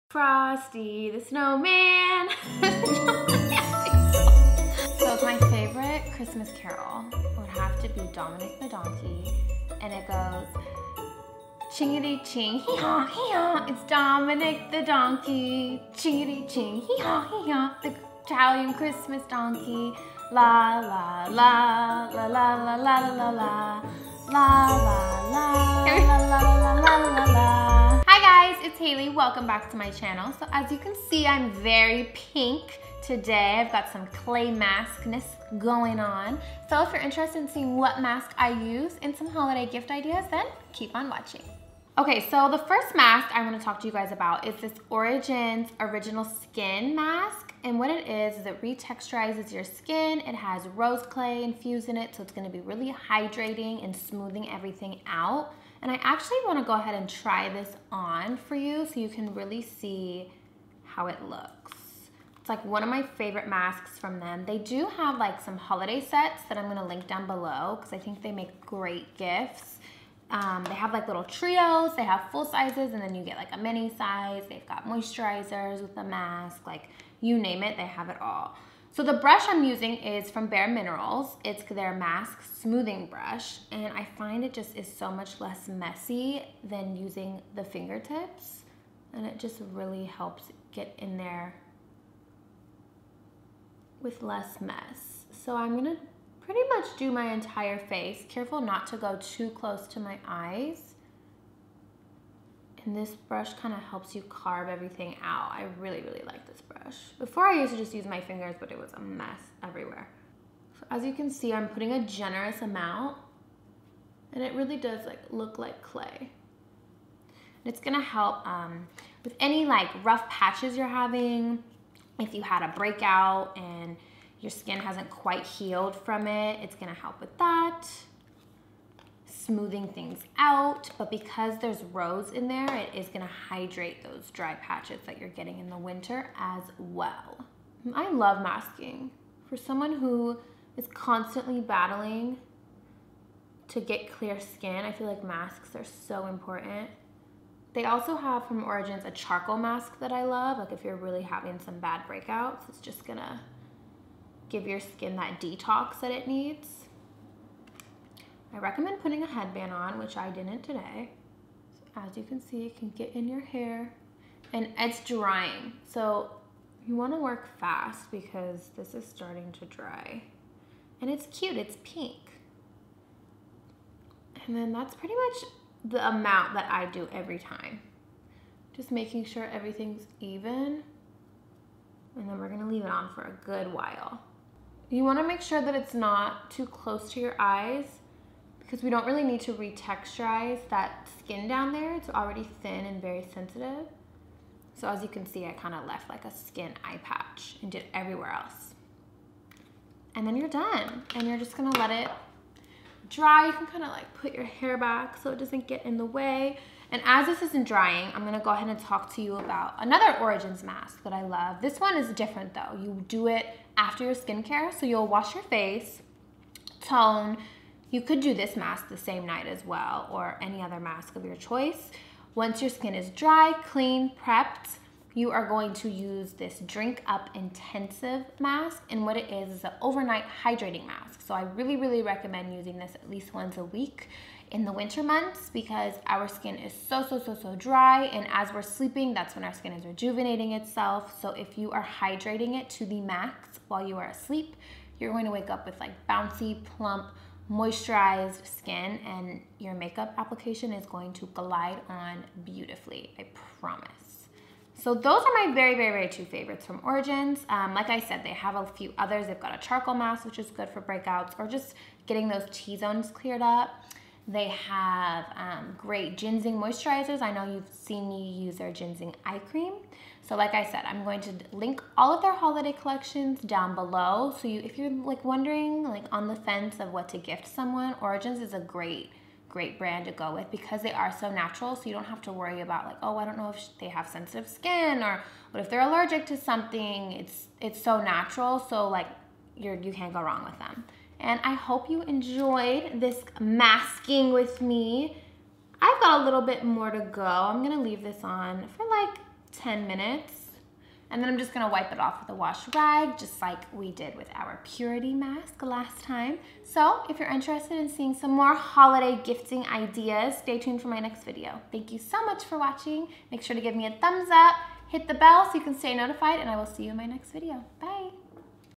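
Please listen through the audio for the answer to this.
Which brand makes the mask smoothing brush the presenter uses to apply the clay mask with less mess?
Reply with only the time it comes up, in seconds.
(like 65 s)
80 s.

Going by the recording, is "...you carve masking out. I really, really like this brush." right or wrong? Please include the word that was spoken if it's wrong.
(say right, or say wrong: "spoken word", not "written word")
wrong: "everything", not "masking".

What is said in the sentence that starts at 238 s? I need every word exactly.
And as we're sleeping, that's when our skin is rejuvenating itself.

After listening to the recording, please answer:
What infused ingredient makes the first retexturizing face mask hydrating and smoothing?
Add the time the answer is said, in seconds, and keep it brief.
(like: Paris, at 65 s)
Rose clay, at 50 s.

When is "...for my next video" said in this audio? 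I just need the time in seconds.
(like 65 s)
310 s.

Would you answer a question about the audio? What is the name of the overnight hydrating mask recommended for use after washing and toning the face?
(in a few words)
Drink Up Intensive.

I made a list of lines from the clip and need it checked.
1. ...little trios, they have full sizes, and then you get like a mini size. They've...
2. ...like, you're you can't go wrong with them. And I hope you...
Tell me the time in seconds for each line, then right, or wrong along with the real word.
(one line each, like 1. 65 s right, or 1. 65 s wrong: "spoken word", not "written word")
1. 71 s right
2. 288 s right.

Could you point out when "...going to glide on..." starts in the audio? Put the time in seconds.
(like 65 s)
250 s.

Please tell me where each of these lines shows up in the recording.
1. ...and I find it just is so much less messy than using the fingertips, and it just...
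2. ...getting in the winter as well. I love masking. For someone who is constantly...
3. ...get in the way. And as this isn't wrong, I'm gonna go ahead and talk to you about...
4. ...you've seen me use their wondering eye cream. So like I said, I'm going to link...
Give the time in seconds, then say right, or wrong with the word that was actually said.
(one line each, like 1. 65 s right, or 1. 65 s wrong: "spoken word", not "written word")
1. 83 s right
2. 135 s right
3. 205 s wrong: "drying", not "wrong"
4. 267 s wrong: "ginseng", not "wondering".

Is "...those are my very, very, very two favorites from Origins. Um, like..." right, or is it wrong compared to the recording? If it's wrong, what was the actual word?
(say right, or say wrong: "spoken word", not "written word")
right.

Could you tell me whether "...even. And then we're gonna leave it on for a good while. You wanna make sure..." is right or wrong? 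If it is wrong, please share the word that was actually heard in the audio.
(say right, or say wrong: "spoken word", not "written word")
right.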